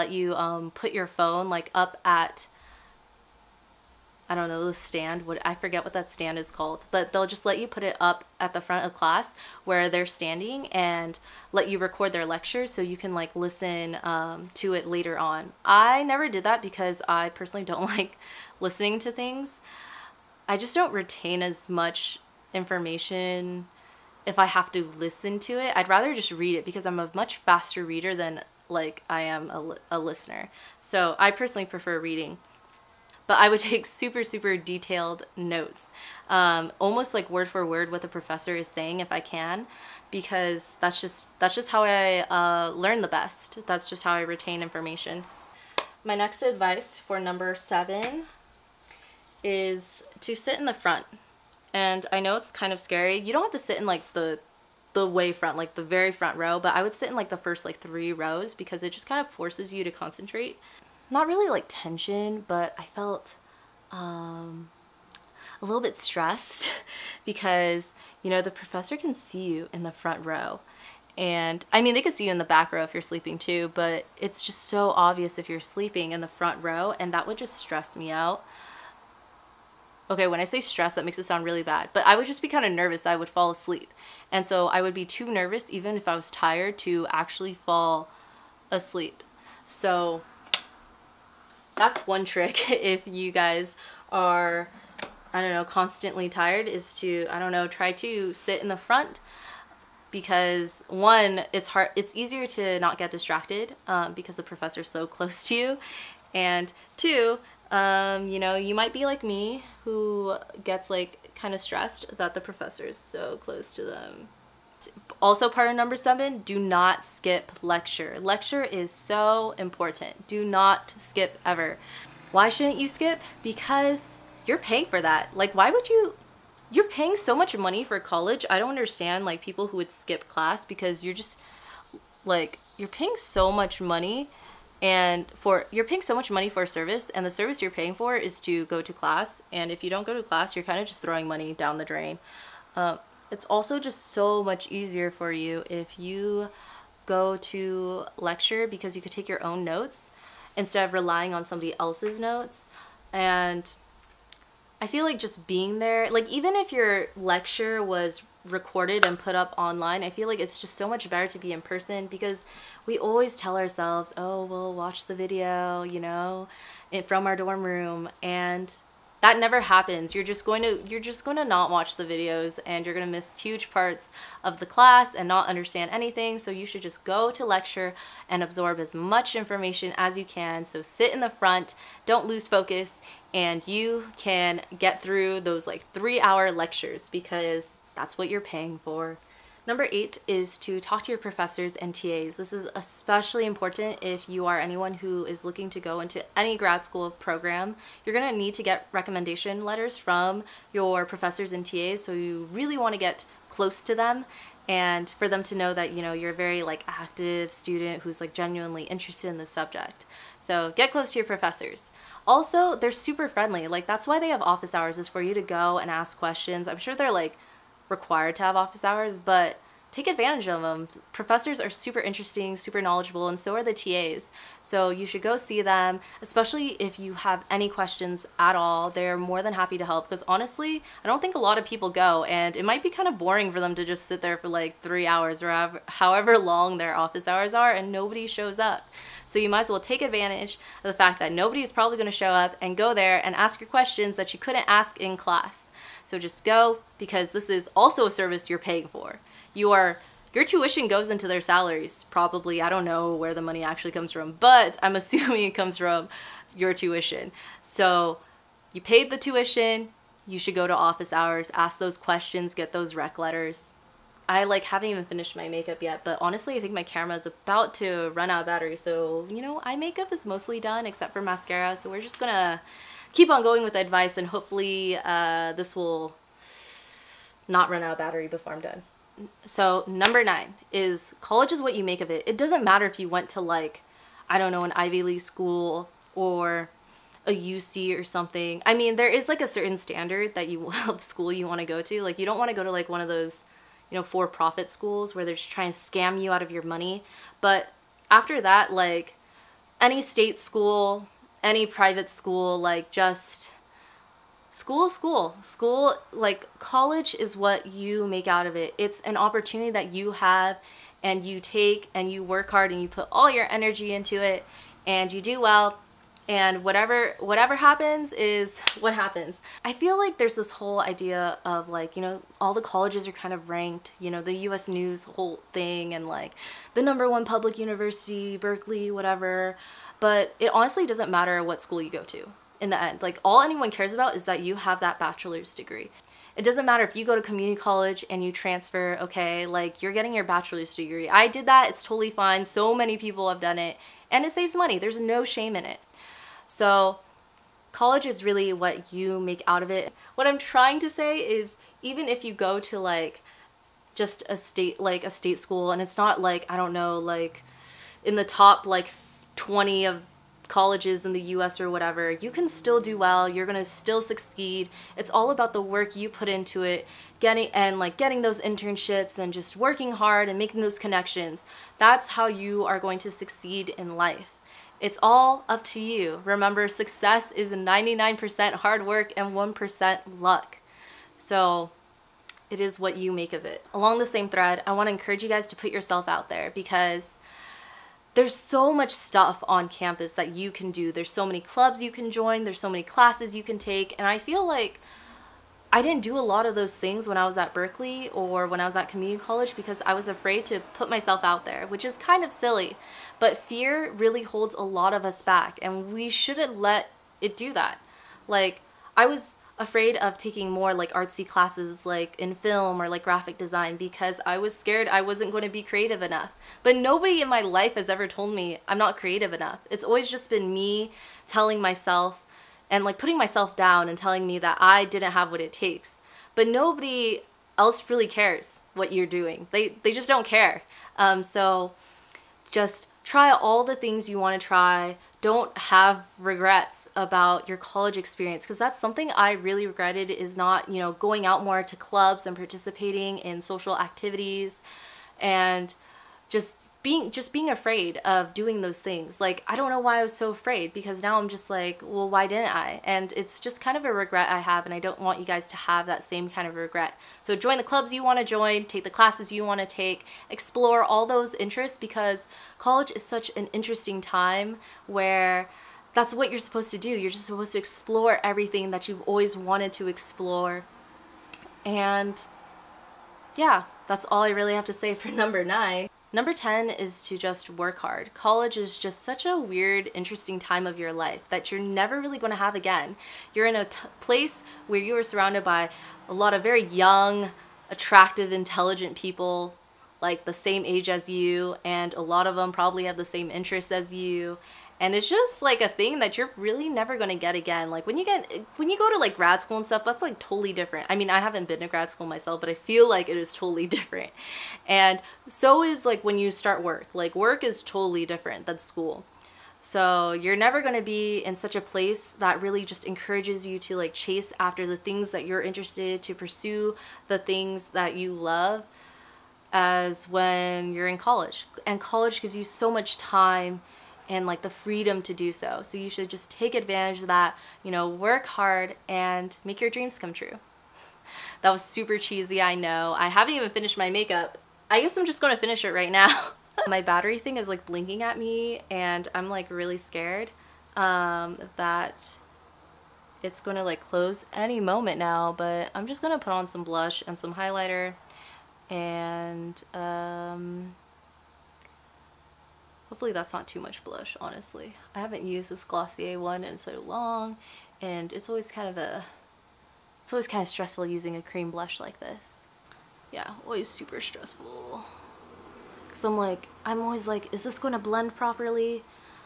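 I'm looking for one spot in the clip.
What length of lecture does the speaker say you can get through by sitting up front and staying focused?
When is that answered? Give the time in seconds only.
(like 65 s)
185 s.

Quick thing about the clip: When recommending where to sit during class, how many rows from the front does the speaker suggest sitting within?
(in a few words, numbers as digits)
3.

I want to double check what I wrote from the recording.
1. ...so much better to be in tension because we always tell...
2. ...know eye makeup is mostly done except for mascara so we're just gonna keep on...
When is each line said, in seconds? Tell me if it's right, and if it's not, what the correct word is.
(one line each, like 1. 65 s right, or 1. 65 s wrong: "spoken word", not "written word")
1. 160 s wrong: "person", not "tension"
2. 269 s right.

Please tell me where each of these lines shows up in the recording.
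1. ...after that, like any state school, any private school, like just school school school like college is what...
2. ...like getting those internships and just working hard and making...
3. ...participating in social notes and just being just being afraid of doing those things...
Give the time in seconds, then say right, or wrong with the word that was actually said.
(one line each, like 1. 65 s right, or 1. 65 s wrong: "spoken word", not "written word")
1. 298 s right
2. 367 s right
3. 442 s wrong: "activities", not "notes".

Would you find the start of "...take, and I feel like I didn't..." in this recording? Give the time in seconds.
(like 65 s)
393 s.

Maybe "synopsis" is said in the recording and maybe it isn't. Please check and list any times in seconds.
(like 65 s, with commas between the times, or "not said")
not said.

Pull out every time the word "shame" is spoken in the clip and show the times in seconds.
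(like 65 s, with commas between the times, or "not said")
345 s.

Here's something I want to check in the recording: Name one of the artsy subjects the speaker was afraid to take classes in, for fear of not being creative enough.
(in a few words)
graphic design.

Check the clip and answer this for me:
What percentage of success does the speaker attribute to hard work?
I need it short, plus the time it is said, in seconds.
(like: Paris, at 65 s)
99%, at 377 s.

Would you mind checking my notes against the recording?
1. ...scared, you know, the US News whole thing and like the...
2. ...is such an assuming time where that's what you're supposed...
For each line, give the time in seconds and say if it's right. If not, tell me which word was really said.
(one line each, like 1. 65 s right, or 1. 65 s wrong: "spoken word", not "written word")
1. 323 s wrong: "ranked", not "scared"
2. 462 s wrong: "interesting", not "assuming".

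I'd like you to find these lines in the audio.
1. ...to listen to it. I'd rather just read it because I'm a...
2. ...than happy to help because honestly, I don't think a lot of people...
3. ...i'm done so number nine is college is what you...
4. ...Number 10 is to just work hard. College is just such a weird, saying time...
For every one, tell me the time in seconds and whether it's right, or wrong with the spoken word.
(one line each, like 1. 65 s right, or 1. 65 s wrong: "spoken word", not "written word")
1. 24 s right
2. 229 s right
3. 278 s right
4. 476 s wrong: "interesting", not "saying".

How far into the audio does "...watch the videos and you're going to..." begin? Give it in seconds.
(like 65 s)
171 s.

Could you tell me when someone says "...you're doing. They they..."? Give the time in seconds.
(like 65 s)
428 s.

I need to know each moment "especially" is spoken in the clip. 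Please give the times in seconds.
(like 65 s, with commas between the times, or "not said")
192 s, 226 s.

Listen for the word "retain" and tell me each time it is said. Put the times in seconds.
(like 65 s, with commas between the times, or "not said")
20 s, 44 s.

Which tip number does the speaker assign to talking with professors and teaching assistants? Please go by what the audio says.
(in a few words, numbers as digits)
8.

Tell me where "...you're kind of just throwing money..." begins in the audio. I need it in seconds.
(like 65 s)
140 s.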